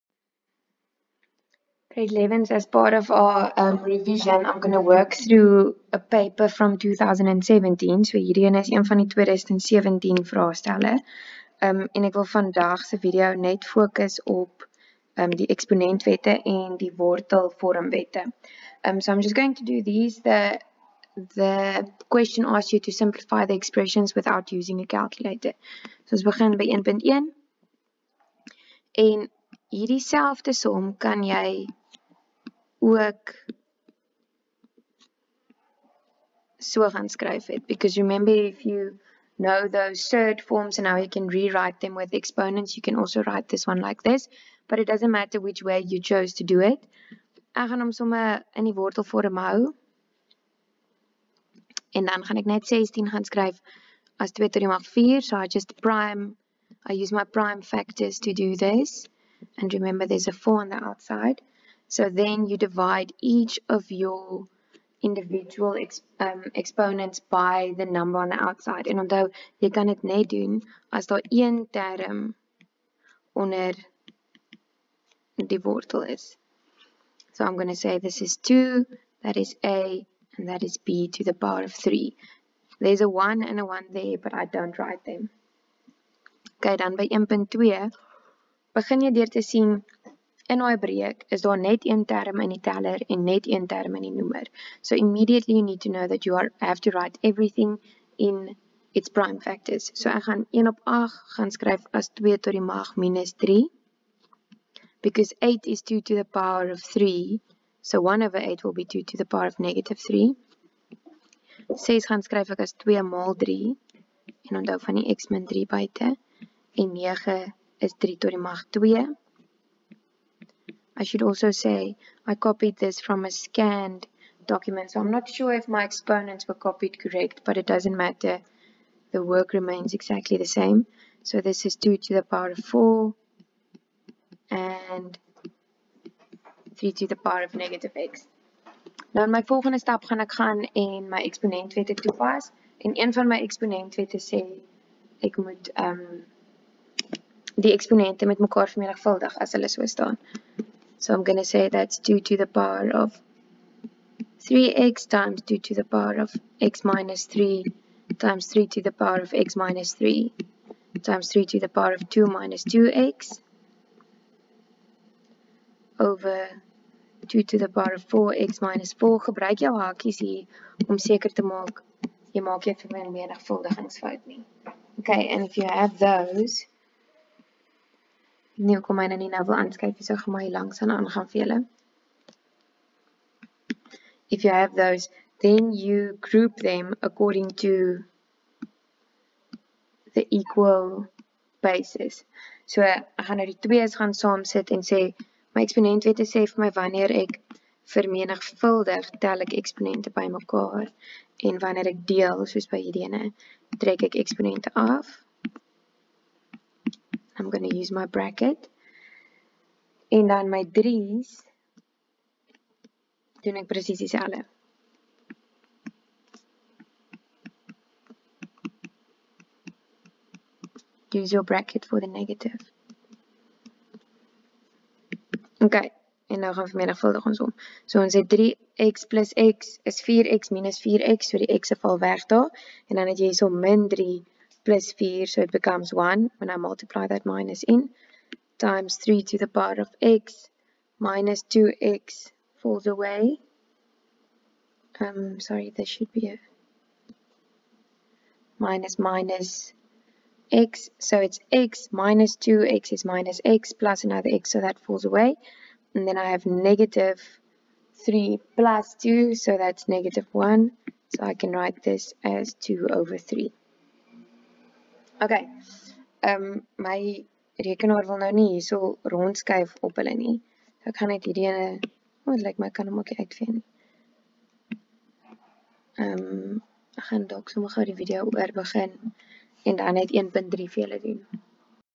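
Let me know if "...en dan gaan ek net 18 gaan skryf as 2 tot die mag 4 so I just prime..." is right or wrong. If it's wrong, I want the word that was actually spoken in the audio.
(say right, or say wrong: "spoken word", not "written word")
wrong: "16", not "18".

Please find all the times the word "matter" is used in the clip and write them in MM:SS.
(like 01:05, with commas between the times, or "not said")
00:45, 02:08.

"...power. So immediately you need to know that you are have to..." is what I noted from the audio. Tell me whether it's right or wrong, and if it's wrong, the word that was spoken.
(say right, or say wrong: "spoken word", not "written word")
wrong: "noemer", not "power".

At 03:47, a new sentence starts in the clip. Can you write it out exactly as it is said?
So ons het 3x plus x is 4x minus 4x, so die x val weg daar.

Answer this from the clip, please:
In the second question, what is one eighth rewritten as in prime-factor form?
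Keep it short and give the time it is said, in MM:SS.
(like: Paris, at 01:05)
2 to the power of -3, at 01:42.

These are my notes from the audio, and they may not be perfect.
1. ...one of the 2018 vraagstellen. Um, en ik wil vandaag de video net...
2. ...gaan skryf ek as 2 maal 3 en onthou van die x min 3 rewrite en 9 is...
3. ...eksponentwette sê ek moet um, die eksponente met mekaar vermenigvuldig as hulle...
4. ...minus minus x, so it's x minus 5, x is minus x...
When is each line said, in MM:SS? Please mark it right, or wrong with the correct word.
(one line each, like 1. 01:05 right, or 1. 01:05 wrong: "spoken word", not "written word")
1. 00:08 wrong: "2017", not "2018"
2. 01:52 wrong: "buite", not "rewrite"
3. 02:23 right
4. 04:08 wrong: "2", not "5".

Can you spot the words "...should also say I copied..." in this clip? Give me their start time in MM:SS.
02:01.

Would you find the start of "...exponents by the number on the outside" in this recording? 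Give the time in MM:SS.
01:06.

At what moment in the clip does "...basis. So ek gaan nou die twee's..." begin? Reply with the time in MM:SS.
03:11.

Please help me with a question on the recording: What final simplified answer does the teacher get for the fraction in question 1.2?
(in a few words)
2/3.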